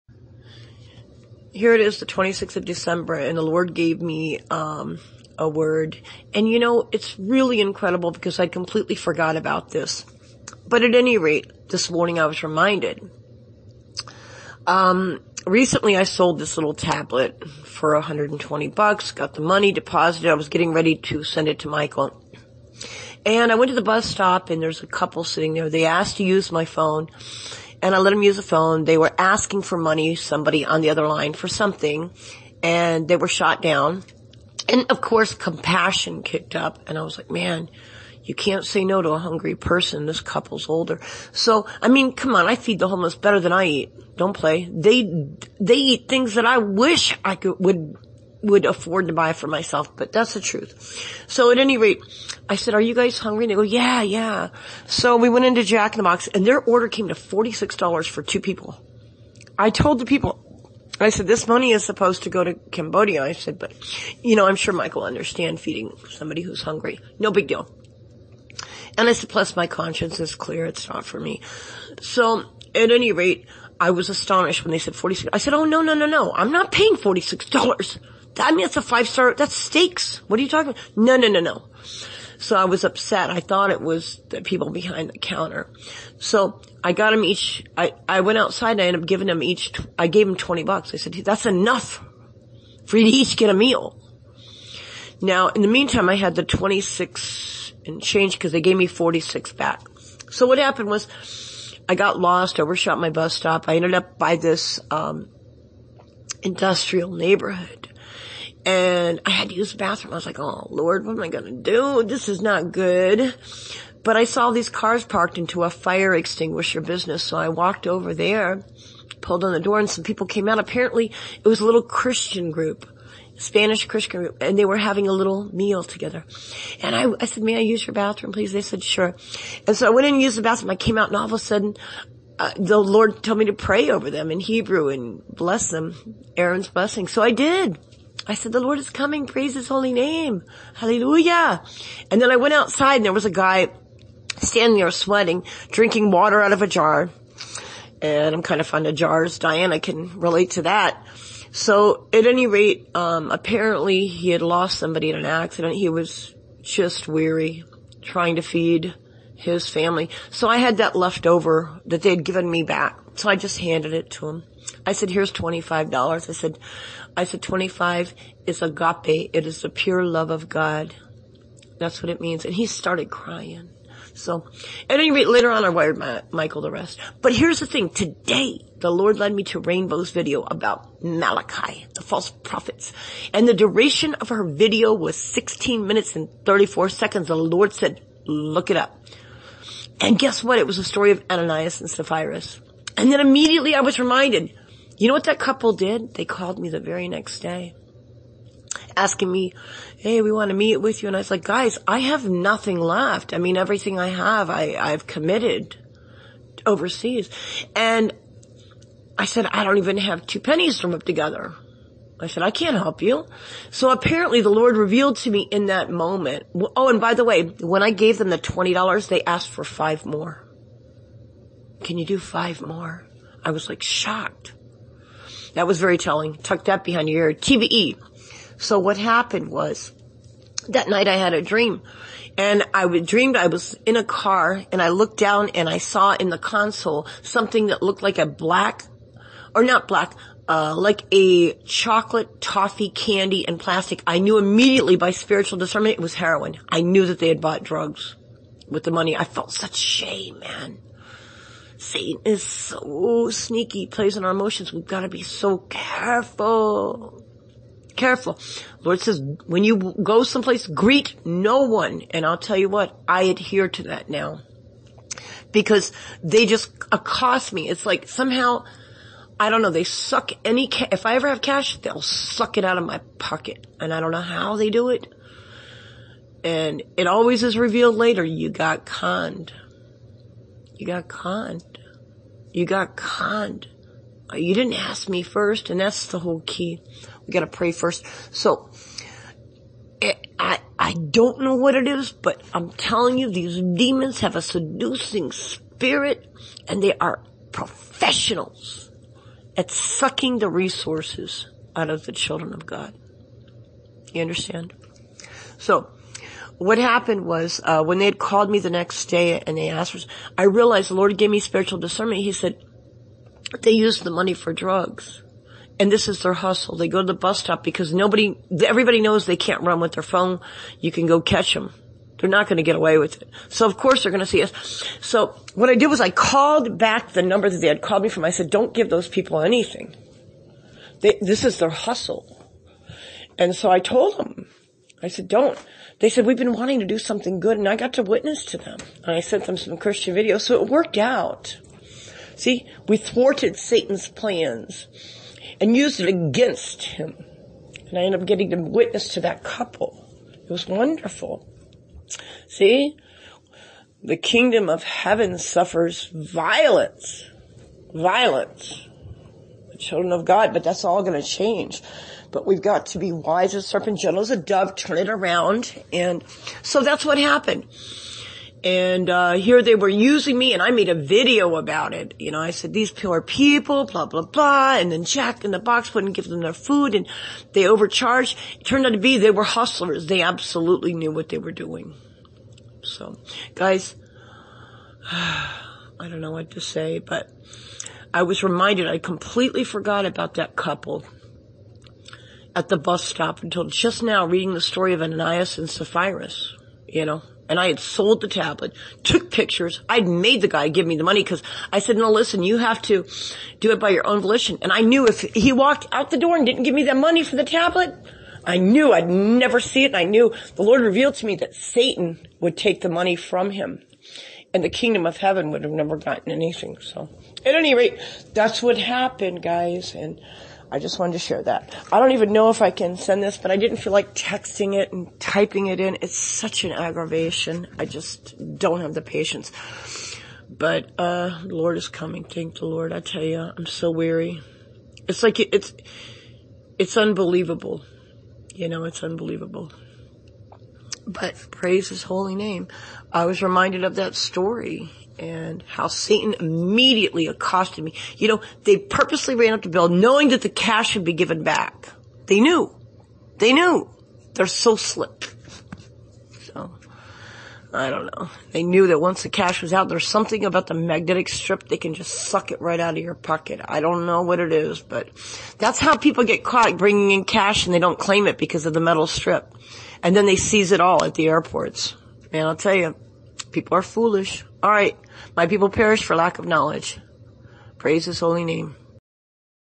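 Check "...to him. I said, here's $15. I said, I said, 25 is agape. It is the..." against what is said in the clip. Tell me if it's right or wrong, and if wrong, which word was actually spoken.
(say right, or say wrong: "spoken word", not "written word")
wrong: "25", not "15".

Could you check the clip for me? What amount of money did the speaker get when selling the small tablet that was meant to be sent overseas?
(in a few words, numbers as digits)
$120.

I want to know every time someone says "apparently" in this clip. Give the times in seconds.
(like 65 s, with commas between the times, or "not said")
120 s, 153 s, 213 s.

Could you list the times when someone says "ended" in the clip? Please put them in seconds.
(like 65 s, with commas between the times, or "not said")
88 s, 103 s, 348 s.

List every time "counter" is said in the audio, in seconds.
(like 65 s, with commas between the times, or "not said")
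85 s.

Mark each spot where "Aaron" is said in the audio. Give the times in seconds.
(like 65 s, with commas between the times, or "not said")
136 s.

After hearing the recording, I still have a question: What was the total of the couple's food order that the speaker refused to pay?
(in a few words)
$46.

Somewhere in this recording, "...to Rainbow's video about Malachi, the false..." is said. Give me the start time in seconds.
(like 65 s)
179 s.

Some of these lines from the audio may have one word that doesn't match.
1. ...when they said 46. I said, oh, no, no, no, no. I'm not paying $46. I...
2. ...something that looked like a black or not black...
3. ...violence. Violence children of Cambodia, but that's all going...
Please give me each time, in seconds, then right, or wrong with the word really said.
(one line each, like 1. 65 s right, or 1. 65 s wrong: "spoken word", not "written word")
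1. 74 s right
2. 237 s right
3. 356 s wrong: "God", not "Cambodia".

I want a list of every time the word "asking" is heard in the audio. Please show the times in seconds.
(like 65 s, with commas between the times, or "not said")
29 s, 198 s.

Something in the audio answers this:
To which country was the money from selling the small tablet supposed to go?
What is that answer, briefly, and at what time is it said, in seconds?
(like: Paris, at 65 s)
Cambodia, at 62 s.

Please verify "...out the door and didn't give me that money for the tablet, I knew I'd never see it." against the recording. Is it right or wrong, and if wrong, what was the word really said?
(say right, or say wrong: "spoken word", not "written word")
right.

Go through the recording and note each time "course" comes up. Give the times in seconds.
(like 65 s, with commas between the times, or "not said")
35 s, 323 s.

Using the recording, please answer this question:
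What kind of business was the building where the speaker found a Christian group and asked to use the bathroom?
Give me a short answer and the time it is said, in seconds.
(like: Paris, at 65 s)
fire extinguisher business, at 115 s.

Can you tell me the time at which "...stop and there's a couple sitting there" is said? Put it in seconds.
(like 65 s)
24 s.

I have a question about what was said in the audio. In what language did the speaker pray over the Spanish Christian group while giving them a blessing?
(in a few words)
Hebrew.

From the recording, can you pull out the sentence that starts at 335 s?
They said, we've been wanting to do something good and I got to witness to them.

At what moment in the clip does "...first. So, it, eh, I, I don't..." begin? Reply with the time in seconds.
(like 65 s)
287 s.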